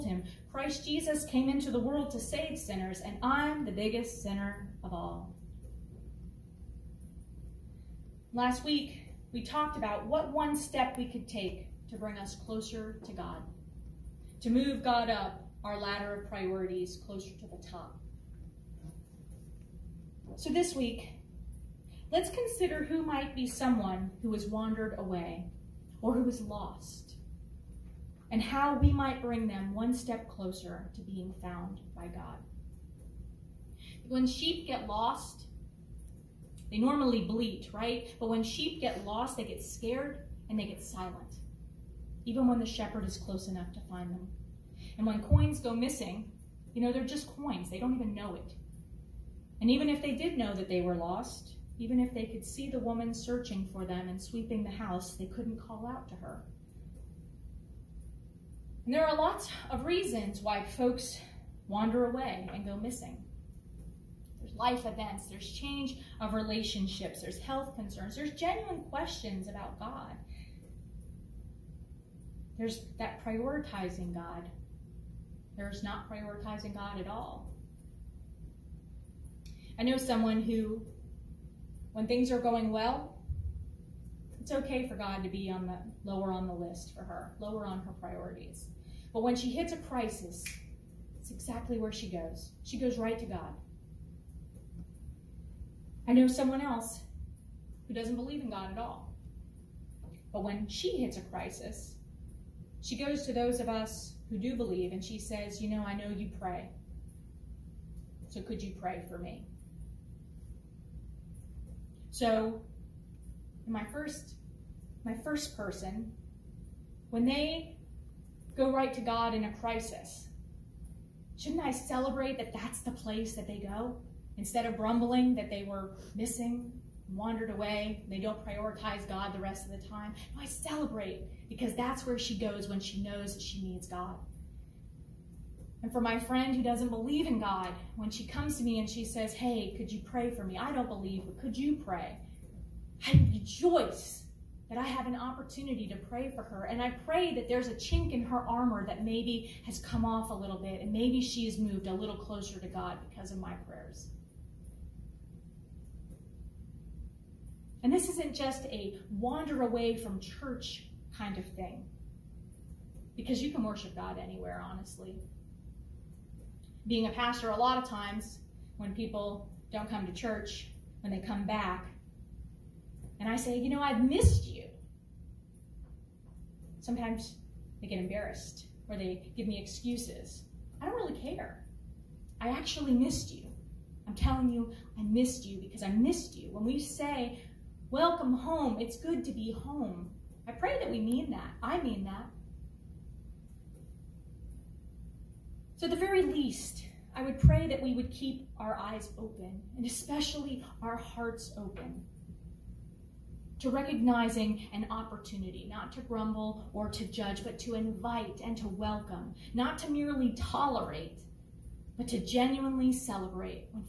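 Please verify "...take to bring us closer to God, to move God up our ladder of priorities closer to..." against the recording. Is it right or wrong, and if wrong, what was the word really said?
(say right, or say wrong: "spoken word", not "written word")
right.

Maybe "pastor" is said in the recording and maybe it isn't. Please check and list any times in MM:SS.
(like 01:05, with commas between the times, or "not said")
02:47.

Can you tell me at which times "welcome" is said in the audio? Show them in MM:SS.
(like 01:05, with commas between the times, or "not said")
03:07, 03:28.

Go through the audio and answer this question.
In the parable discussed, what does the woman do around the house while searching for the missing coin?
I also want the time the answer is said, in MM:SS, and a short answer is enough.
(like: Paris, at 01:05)
Sweeping, at 00:54.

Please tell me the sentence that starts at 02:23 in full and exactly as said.
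I rejoice that I have an opportunity to pray for her.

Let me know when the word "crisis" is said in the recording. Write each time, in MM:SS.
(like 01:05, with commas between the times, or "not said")
01:29, 01:41, 01:59.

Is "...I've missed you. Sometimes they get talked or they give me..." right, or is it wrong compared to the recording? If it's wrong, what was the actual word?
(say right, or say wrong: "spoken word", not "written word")
wrong: "embarrassed", not "talked".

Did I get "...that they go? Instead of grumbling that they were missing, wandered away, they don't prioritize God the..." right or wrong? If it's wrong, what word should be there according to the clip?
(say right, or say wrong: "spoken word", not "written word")
right.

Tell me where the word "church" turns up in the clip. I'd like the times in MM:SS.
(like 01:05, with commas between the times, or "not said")
02:40, 02:50.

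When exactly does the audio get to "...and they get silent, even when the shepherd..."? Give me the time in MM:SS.
00:40.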